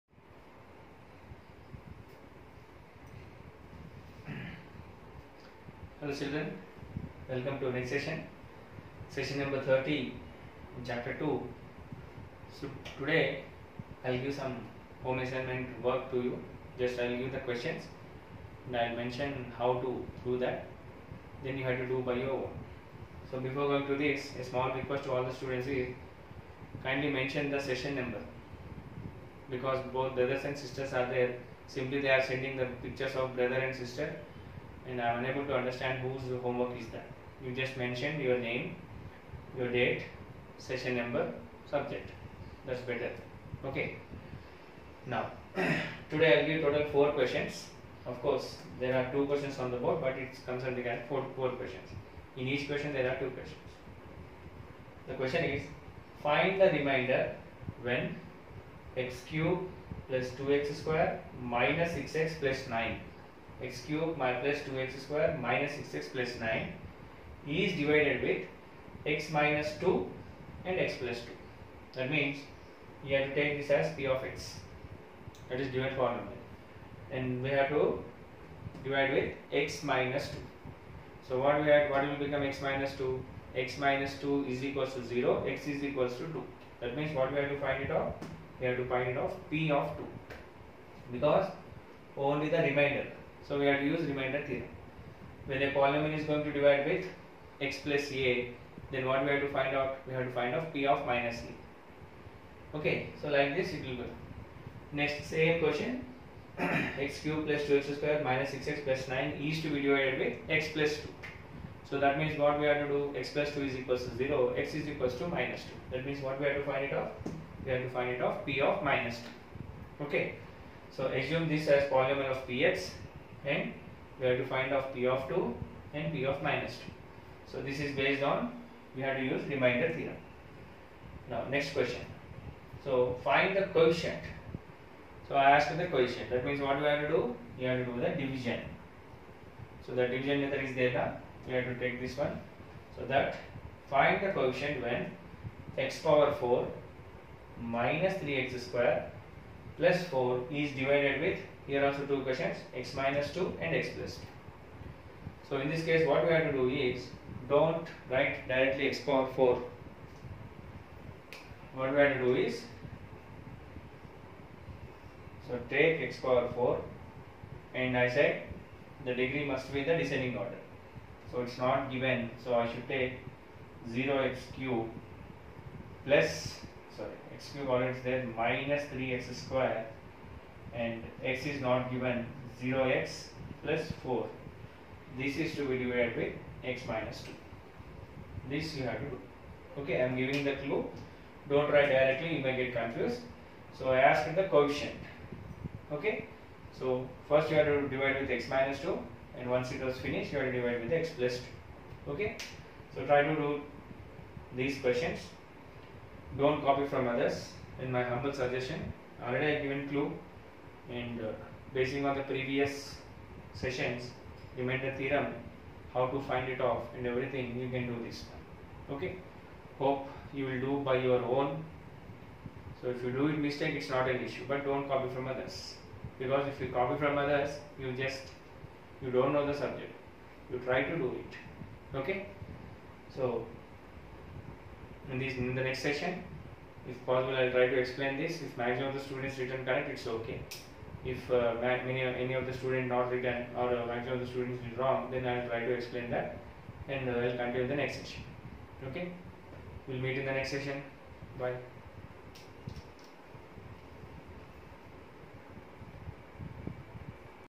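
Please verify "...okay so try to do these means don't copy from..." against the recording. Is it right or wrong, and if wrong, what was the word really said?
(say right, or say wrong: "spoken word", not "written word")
wrong: "questions", not "means".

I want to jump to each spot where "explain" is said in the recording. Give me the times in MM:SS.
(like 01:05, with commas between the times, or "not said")
03:57, 04:05.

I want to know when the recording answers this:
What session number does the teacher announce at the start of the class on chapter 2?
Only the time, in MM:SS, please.
00:09.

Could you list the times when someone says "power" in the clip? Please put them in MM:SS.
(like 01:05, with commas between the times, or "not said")
02:25, 02:39, 02:46.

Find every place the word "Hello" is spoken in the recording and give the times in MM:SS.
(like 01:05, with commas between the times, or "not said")
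00:06.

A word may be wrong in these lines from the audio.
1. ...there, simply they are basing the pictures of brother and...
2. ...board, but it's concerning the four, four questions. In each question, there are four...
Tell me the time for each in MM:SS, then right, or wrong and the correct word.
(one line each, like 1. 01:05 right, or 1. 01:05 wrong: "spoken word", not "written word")
1. 00:31 wrong: "sending", not "basing"
2. 00:49 wrong: "two", not "four".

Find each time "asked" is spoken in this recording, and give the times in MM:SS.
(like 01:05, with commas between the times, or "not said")
02:15, 03:13.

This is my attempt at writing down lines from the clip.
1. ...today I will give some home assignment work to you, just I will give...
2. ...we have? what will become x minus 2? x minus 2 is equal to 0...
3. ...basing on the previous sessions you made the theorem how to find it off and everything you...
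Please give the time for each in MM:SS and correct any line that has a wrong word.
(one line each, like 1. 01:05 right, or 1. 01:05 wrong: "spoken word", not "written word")
1. 00:12 right
2. 01:21 right
3. 03:31 right.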